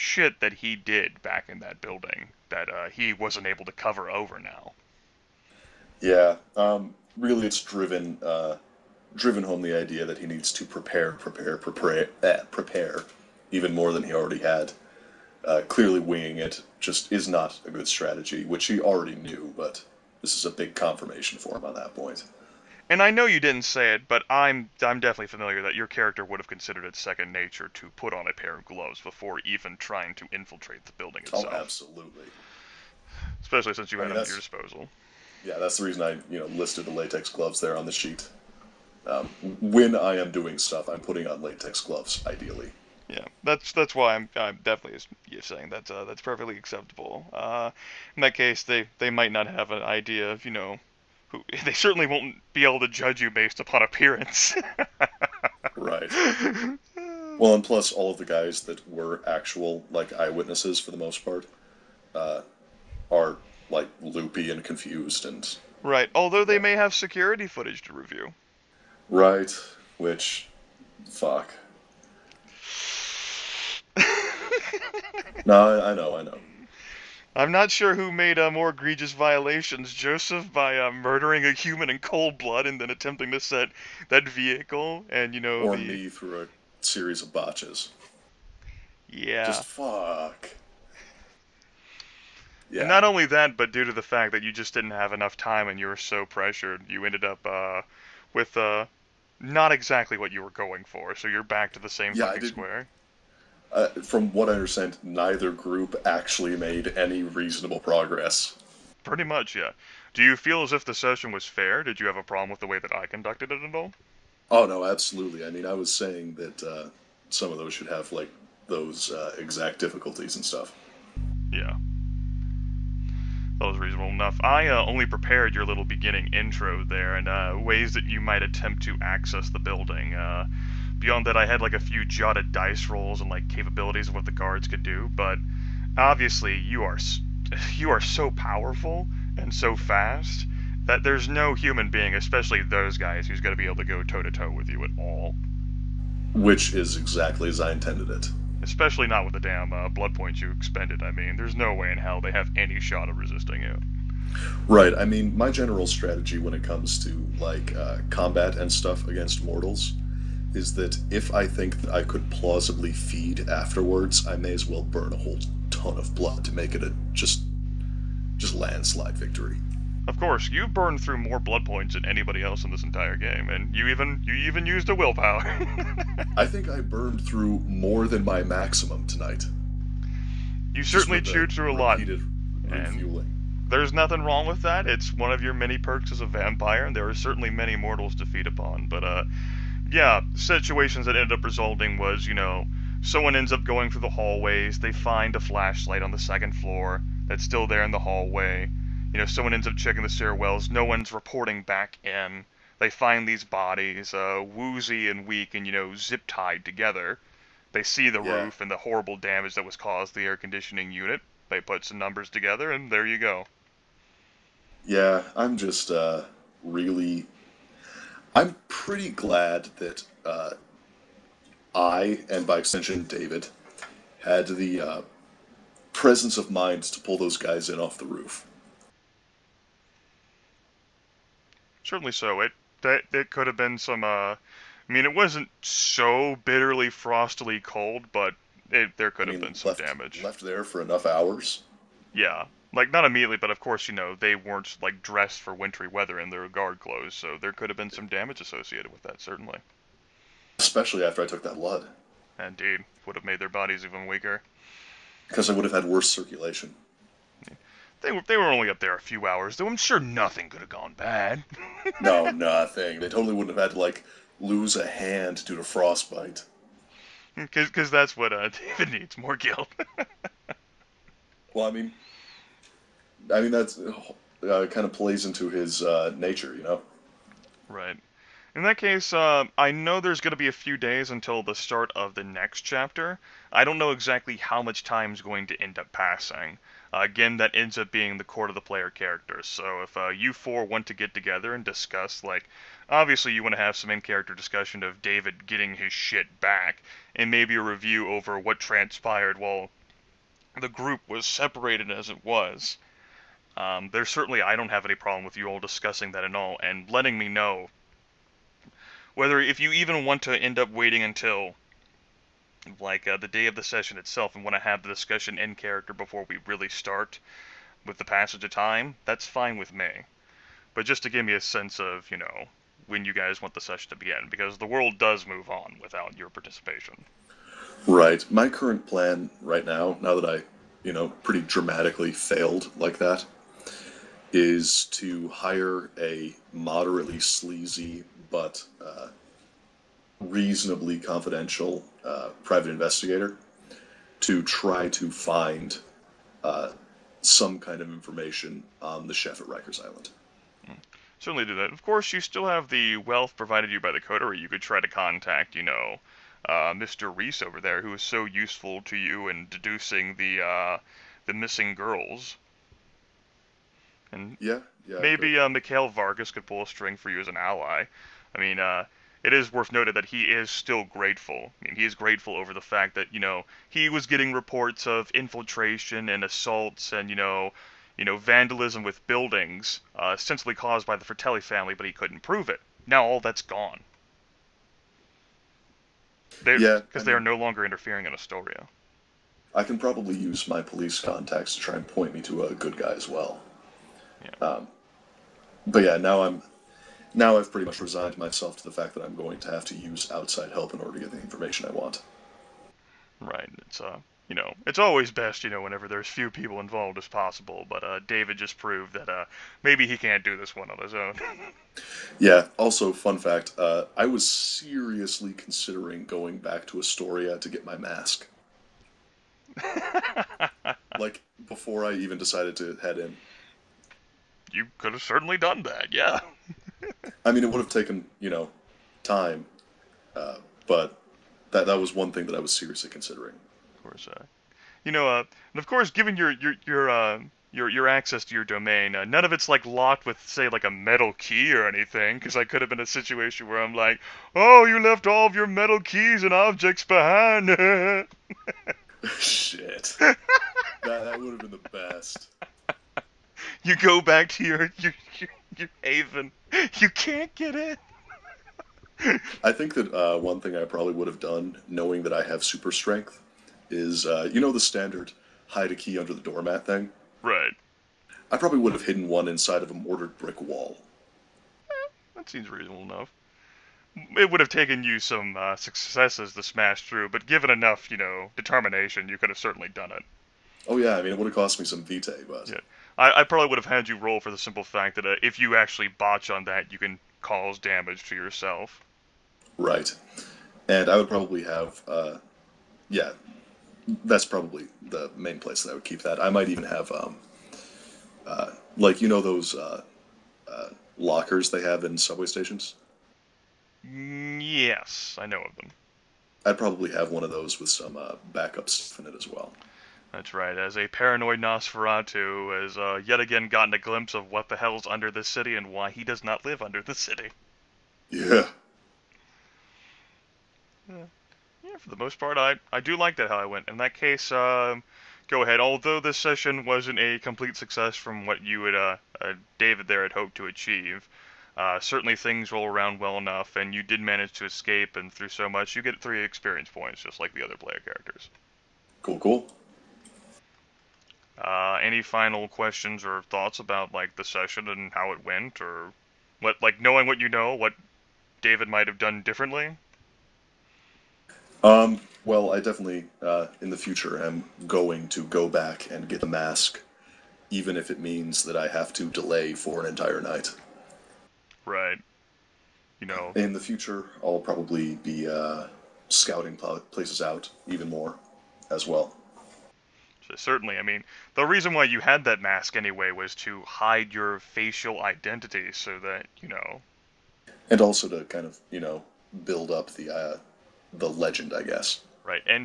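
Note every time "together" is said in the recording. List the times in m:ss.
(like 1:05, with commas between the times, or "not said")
3:26, 3:32, 4:51.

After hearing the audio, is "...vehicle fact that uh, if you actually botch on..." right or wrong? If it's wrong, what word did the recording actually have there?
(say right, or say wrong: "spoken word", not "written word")
wrong: "simple", not "vehicle".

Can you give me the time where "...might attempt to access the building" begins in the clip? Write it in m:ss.
2:08.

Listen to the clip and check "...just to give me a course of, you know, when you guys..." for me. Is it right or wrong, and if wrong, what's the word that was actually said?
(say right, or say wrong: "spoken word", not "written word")
wrong: "sense", not "course".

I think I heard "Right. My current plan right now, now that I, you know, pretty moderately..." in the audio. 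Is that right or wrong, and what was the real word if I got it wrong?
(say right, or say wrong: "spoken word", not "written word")
wrong: "dramatically", not "moderately".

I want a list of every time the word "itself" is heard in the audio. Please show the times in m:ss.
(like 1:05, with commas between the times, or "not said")
0:31, 5:13.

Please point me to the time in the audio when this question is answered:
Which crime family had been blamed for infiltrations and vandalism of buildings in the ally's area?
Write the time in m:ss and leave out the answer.
6:21.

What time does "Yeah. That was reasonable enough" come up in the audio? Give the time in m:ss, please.
2:01.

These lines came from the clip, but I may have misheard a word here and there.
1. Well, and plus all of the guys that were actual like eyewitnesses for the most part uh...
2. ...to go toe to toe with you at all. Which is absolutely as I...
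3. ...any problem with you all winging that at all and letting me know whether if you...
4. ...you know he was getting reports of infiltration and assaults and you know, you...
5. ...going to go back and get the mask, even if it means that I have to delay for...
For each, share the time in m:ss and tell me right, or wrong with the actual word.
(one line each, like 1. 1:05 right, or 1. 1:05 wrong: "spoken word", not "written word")
1. 0:57 right
2. 2:23 wrong: "exactly", not "absolutely"
3. 5:04 wrong: "discussing", not "winging"
4. 6:13 right
5. 9:14 right.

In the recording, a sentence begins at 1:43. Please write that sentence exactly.
Uh, from what I understand, neither group actually made any reasonable progress.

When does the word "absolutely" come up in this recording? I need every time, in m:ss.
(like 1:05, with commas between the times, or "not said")
0:31, 1:54.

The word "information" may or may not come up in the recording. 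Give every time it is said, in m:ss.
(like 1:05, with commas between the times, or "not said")
5:47, 6:41.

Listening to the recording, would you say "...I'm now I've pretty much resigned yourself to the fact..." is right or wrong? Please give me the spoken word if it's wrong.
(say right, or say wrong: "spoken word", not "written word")
wrong: "myself", not "yourself".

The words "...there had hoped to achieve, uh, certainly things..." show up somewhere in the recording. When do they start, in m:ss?
8:49.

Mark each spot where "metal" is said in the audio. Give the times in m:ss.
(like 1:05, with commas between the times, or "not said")
7:20, 7:25.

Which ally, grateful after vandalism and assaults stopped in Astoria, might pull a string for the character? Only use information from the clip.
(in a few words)
Mikhail Vargas.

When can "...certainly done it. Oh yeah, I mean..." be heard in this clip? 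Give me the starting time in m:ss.
7:59.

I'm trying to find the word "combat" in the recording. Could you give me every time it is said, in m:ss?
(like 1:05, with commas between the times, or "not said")
2:38.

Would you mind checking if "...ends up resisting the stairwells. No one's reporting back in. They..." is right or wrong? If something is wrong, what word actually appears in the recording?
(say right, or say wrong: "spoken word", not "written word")
wrong: "checking", not "resisting".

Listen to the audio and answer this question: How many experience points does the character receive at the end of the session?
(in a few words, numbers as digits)
3.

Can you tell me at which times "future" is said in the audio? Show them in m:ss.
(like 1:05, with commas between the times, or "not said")
9:13, 9:23.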